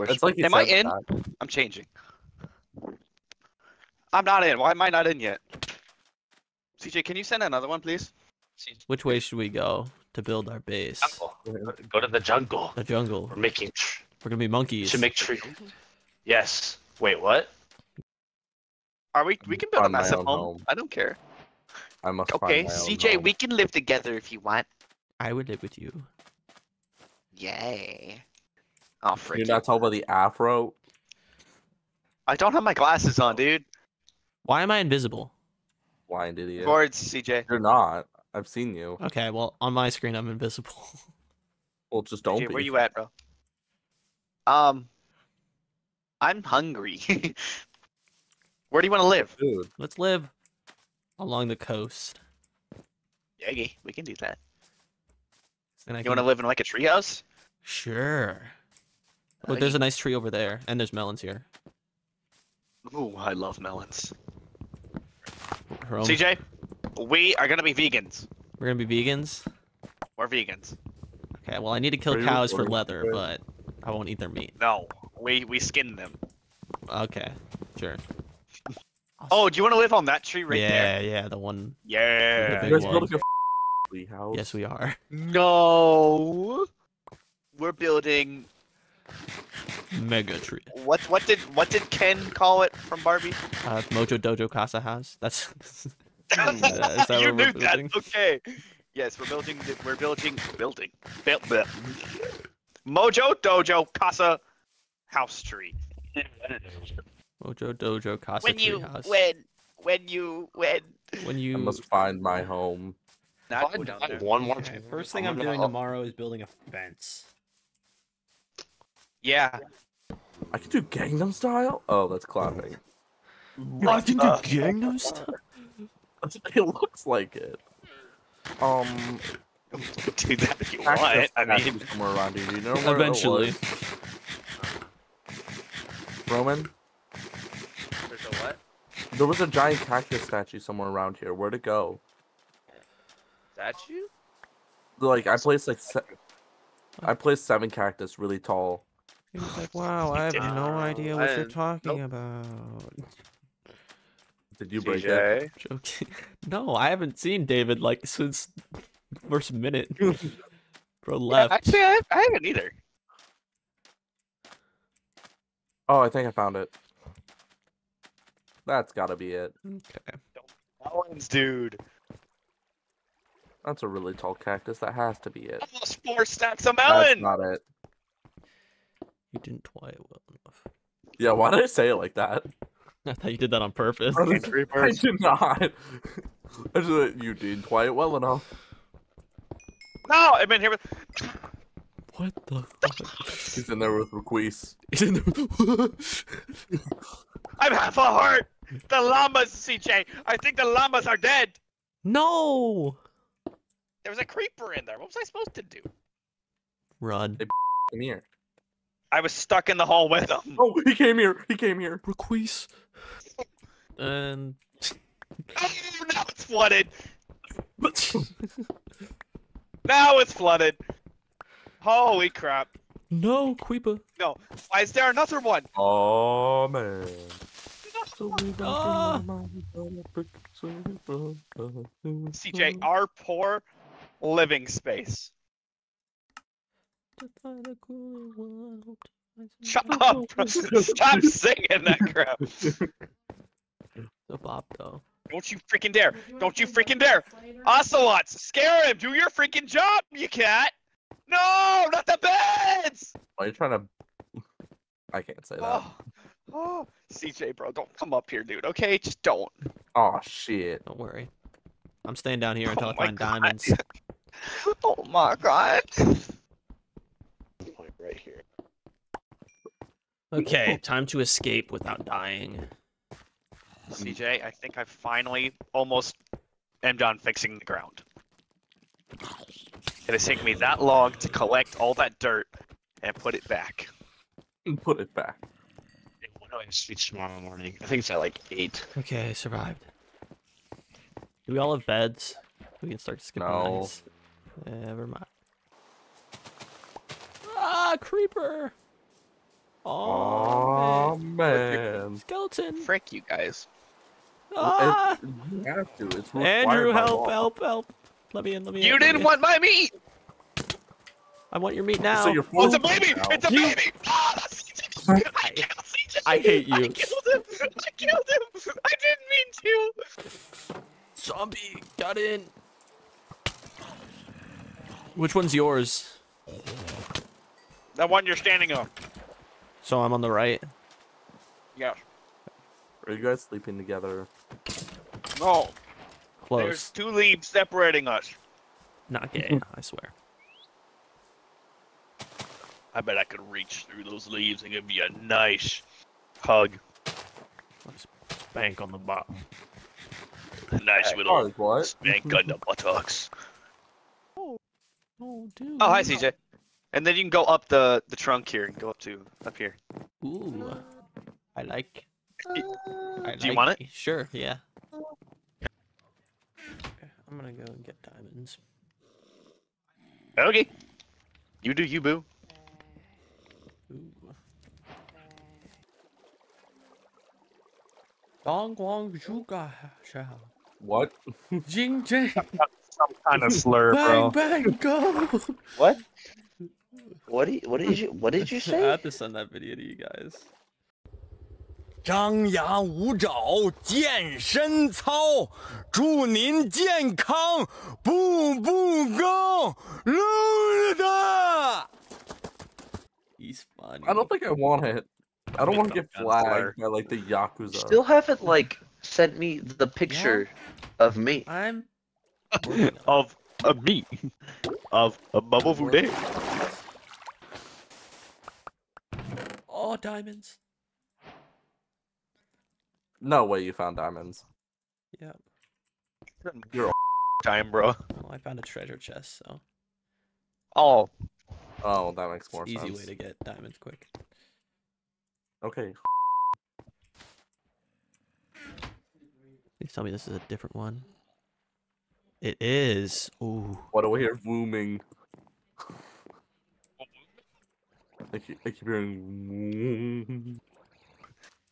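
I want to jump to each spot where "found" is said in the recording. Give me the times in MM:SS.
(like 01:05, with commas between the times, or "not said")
02:46, 07:03, 07:08.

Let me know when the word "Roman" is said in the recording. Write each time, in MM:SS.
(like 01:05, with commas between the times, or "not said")
02:16.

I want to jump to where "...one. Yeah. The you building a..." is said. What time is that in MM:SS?
01:21.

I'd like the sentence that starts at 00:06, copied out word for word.
CJ, can you send another one, please?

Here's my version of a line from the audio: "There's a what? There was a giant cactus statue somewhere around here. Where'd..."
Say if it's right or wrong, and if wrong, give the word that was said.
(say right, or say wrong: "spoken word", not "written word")
right.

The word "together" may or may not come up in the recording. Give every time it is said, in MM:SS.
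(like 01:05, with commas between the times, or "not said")
00:23, 05:33.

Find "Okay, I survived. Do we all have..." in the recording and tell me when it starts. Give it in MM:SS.
04:48.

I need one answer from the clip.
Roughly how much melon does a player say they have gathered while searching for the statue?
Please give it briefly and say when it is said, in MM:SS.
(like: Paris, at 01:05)
Almost four stacks, at 02:55.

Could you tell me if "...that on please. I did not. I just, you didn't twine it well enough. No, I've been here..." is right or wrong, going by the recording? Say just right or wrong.
wrong.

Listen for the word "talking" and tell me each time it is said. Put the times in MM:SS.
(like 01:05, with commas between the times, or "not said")
00:29, 02:31.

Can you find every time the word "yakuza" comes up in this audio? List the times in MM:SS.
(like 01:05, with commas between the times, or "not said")
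06:47.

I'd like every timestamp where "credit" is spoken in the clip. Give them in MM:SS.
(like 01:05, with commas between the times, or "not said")
not said.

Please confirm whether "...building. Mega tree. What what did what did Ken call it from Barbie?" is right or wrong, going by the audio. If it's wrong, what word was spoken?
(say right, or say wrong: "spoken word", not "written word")
right.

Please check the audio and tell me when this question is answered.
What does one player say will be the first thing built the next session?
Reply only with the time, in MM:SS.
01:56.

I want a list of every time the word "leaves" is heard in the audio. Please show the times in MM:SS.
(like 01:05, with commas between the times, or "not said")
05:37, 05:44.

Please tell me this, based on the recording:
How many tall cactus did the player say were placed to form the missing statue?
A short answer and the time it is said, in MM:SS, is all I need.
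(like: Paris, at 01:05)
7, at 02:27.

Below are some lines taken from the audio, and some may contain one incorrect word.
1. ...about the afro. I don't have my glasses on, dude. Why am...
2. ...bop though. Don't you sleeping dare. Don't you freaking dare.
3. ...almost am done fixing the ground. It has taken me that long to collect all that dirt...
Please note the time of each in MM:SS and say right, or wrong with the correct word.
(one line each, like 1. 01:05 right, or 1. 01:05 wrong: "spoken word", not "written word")
1. 00:29 right
2. 04:04 wrong: "freaking", not "sleeping"
3. 04:35 right.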